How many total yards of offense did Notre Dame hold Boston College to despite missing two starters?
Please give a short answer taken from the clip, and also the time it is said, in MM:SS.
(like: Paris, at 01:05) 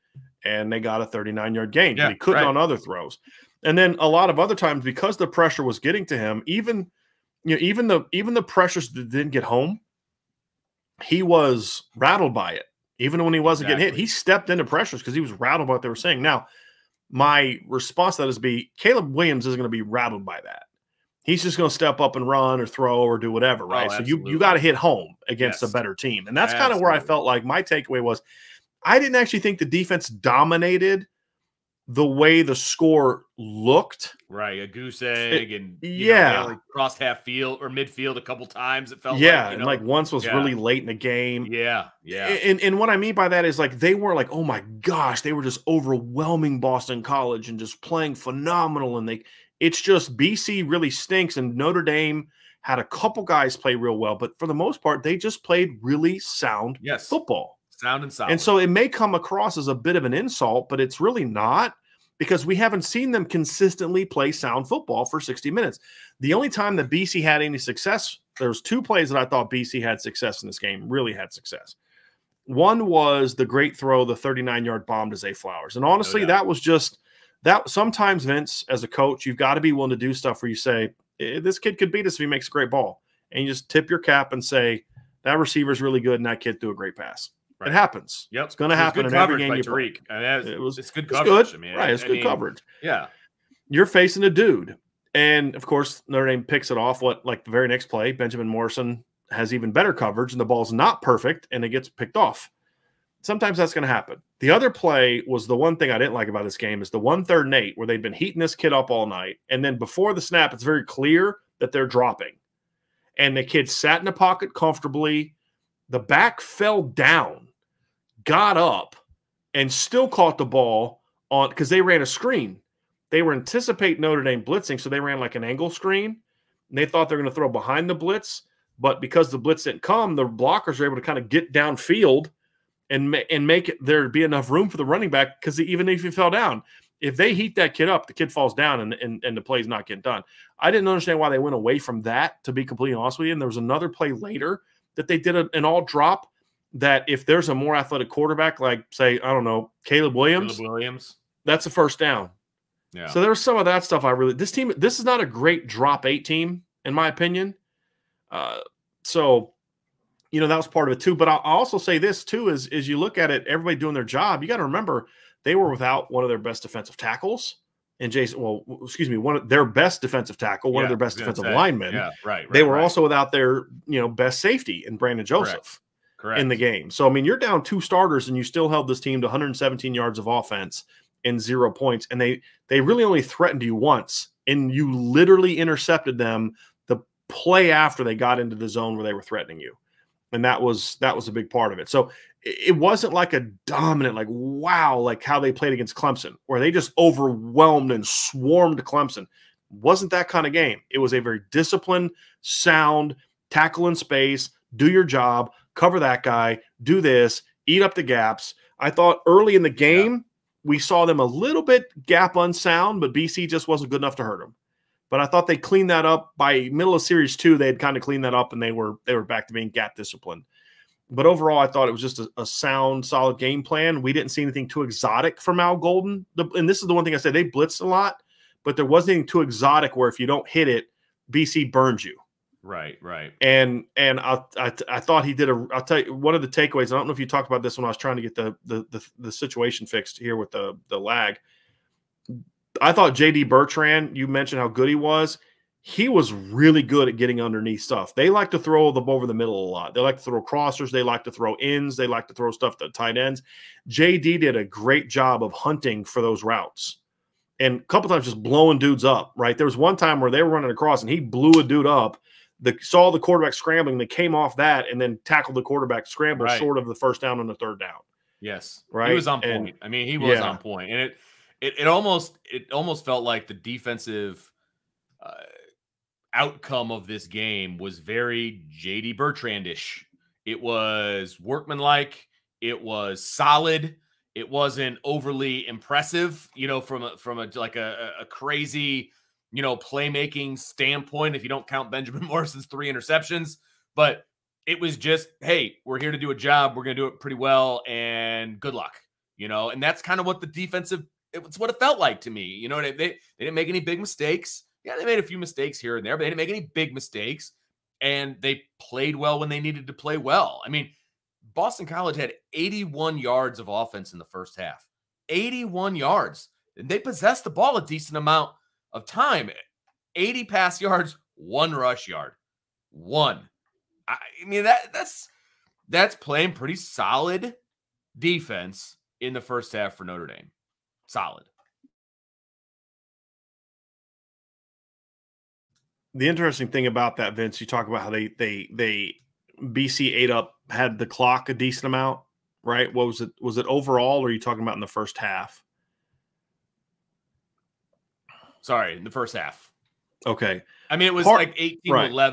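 117, at 02:59.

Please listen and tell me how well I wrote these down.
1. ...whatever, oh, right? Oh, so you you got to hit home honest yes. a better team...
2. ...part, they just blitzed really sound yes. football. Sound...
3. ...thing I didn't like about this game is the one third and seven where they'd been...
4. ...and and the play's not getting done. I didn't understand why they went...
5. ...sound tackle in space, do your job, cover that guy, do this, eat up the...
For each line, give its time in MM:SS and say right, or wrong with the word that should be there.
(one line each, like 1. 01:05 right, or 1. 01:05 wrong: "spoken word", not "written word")
1. 00:23 wrong: "against", not "honest"
2. 00:54 wrong: "played", not "blitzed"
3. 01:45 wrong: "eight", not "seven"
4. 02:18 right
5. 03:22 right.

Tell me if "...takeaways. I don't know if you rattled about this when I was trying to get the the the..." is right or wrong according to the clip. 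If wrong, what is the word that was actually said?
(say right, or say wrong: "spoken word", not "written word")
wrong: "talked", not "rattled".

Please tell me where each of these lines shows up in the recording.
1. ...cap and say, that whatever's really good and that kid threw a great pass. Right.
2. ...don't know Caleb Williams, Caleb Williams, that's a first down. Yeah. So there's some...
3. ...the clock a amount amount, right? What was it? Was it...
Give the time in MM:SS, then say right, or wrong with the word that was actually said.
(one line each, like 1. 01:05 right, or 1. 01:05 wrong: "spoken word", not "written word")
1. 01:23 wrong: "receiver", not "whatever"
2. 02:29 right
3. 05:40 wrong: "decent", not "amount".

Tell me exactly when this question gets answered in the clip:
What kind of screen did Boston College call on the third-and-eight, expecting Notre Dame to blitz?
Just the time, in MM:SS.
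02:05.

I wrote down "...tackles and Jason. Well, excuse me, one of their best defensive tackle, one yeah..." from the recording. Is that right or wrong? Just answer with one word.
right.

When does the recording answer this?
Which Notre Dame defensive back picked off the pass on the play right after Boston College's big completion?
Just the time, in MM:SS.
01:38.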